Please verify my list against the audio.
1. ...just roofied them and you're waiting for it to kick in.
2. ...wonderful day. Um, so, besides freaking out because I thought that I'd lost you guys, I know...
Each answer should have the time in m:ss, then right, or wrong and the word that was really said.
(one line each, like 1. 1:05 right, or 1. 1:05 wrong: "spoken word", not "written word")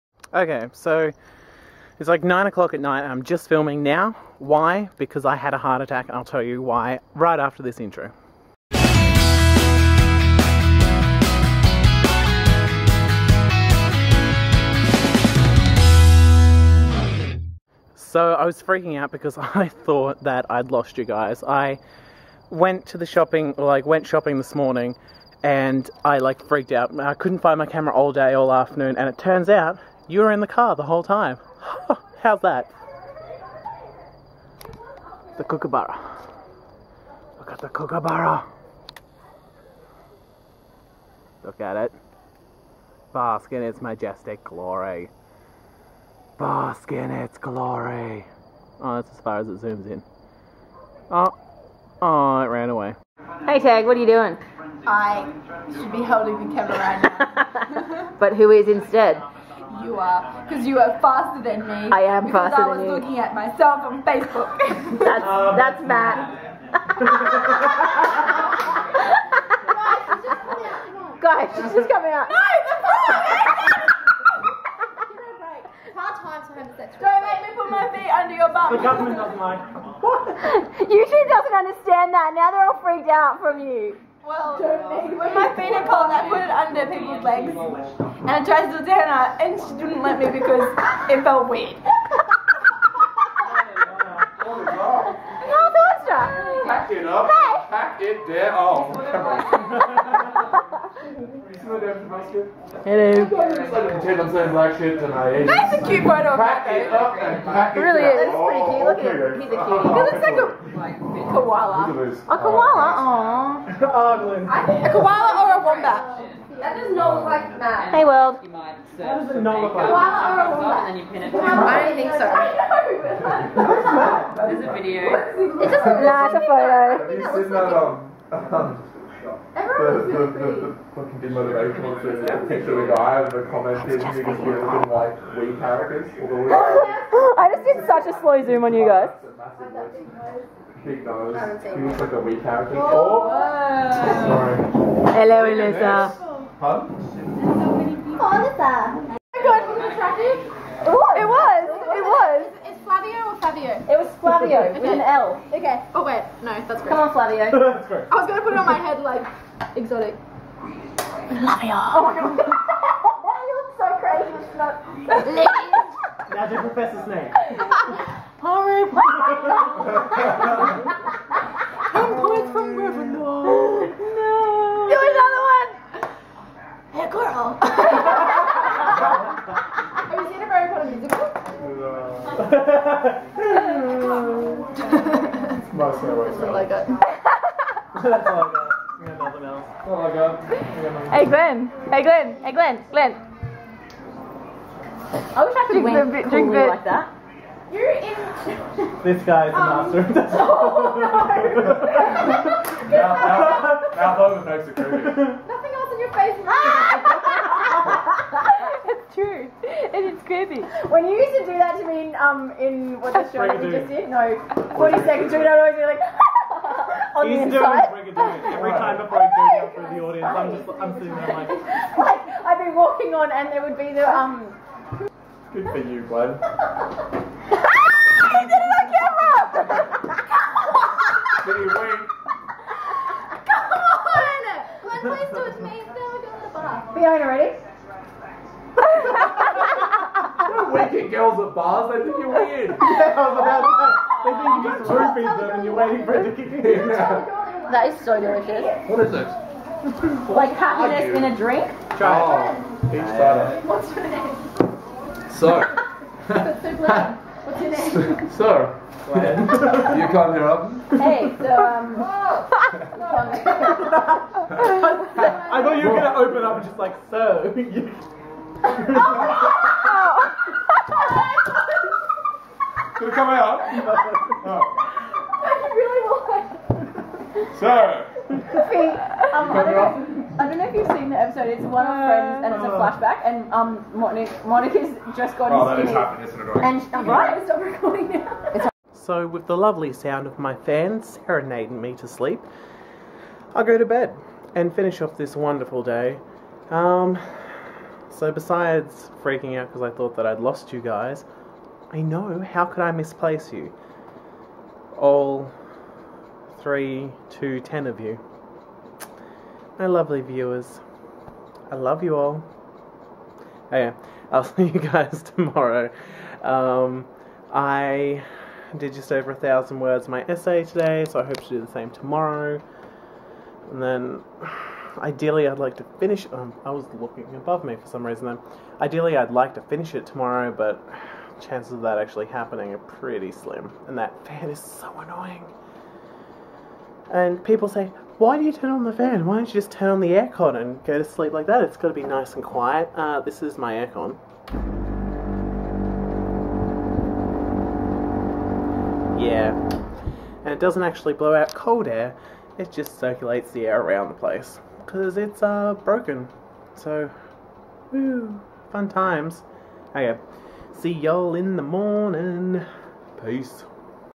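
1. 4:04 right
2. 4:55 right.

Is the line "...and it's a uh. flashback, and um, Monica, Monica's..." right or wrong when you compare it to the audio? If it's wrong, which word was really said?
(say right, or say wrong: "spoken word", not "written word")
right.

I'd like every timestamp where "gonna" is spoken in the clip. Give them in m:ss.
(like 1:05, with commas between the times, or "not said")
2:38, 4:25.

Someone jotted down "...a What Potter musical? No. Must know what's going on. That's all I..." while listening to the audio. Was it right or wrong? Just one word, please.
wrong.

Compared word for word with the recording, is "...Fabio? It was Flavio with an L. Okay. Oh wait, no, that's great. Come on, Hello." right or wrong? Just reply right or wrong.
wrong.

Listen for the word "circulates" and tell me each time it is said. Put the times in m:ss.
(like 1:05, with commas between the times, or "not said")
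5:52.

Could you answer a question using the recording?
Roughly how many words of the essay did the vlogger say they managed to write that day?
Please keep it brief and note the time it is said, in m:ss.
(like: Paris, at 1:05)
Just over 1000, at 5:18.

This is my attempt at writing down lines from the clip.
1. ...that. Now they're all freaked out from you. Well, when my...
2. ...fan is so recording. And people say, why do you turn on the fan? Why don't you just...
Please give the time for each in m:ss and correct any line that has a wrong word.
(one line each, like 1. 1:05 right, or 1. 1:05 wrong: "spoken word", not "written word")
1. 1:22 right
2. 5:34 wrong: "annoying", not "recording".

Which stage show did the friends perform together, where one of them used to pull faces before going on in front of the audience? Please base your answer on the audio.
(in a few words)
Brigadoon.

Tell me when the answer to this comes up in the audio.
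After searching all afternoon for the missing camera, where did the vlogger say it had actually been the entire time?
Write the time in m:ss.
0:30.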